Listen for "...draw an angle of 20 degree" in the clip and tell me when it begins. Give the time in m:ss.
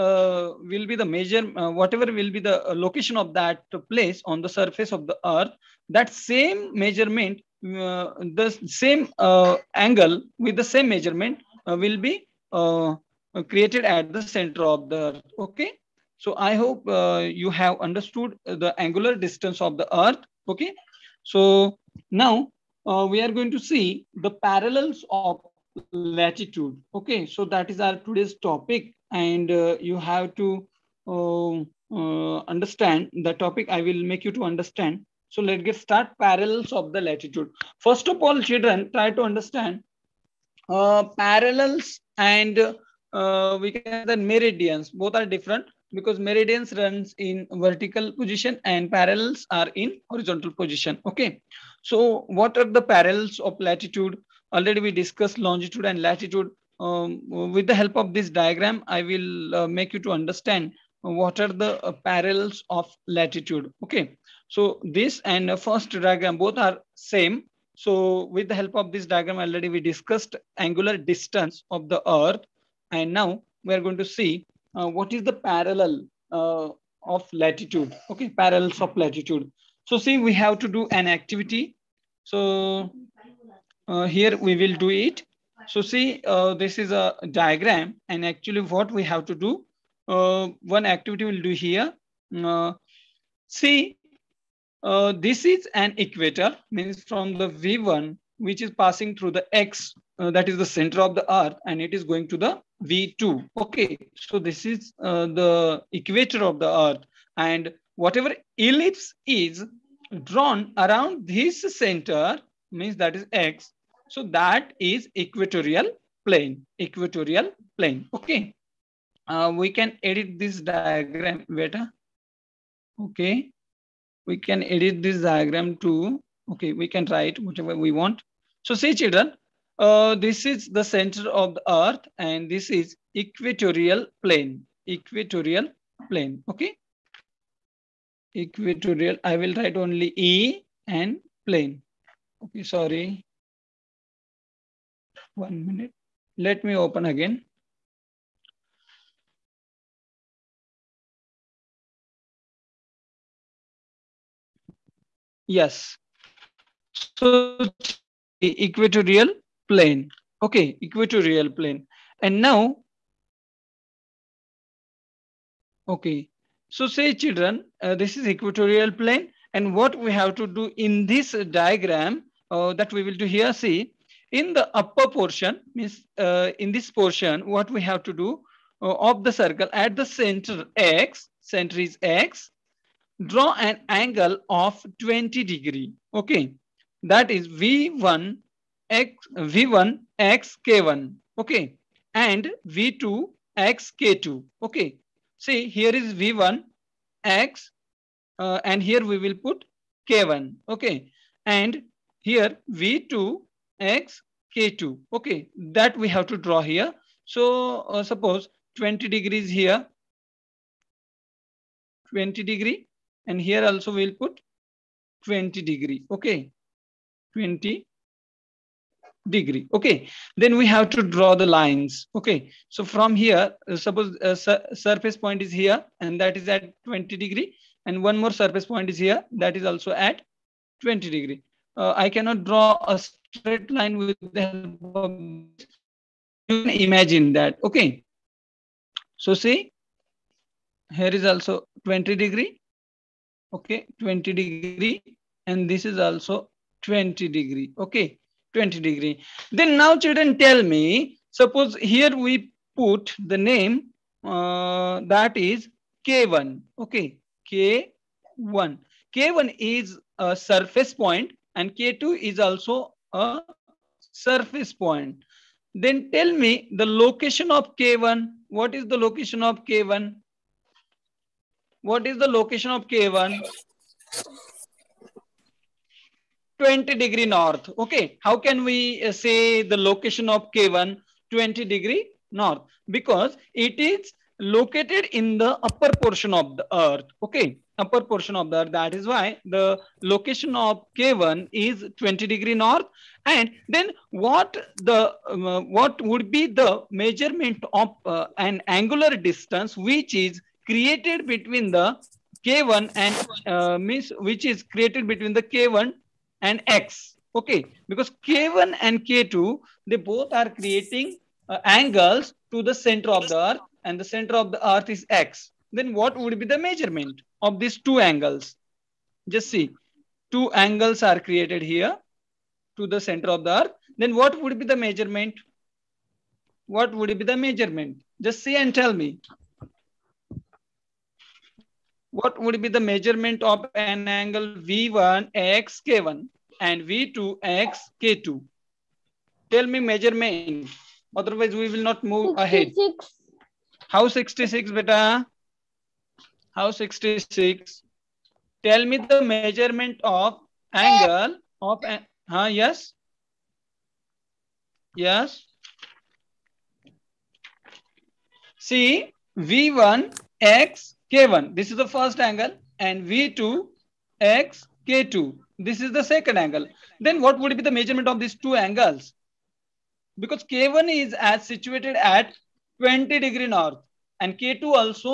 3:03.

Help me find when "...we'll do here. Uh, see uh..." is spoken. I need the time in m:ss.
1:31.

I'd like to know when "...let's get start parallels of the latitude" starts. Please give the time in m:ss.
0:35.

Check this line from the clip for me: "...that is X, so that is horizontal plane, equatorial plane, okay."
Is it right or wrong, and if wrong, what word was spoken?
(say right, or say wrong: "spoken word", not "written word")
wrong: "equatorial", not "horizontal".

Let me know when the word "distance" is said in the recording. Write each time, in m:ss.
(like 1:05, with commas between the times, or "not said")
0:19, 1:10, 4:59.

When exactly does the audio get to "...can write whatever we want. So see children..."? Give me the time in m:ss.
2:06.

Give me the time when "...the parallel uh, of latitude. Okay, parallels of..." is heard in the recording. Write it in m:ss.
1:15.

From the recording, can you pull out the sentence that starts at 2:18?
Equatorial, I will write only E and plane.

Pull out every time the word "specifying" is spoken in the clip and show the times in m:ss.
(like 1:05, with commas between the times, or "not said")
not said.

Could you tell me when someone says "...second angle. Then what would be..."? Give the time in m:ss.
6:06.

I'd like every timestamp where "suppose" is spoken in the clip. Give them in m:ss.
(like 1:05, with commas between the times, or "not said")
3:28, 3:43, 4:11.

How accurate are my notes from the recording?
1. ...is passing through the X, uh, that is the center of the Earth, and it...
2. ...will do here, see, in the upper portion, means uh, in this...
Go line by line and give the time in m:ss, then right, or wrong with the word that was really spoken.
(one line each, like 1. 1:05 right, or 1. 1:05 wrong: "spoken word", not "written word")
1. 1:38 right
2. 2:53 right.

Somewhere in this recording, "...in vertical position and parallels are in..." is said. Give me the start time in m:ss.
0:47.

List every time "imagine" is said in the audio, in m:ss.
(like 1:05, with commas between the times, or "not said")
3:56.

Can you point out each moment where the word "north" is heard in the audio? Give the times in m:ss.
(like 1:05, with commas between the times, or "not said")
4:37, 4:42, 4:52, 6:13.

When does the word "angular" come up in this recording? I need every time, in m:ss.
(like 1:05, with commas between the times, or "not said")
0:18, 1:10, 4:58.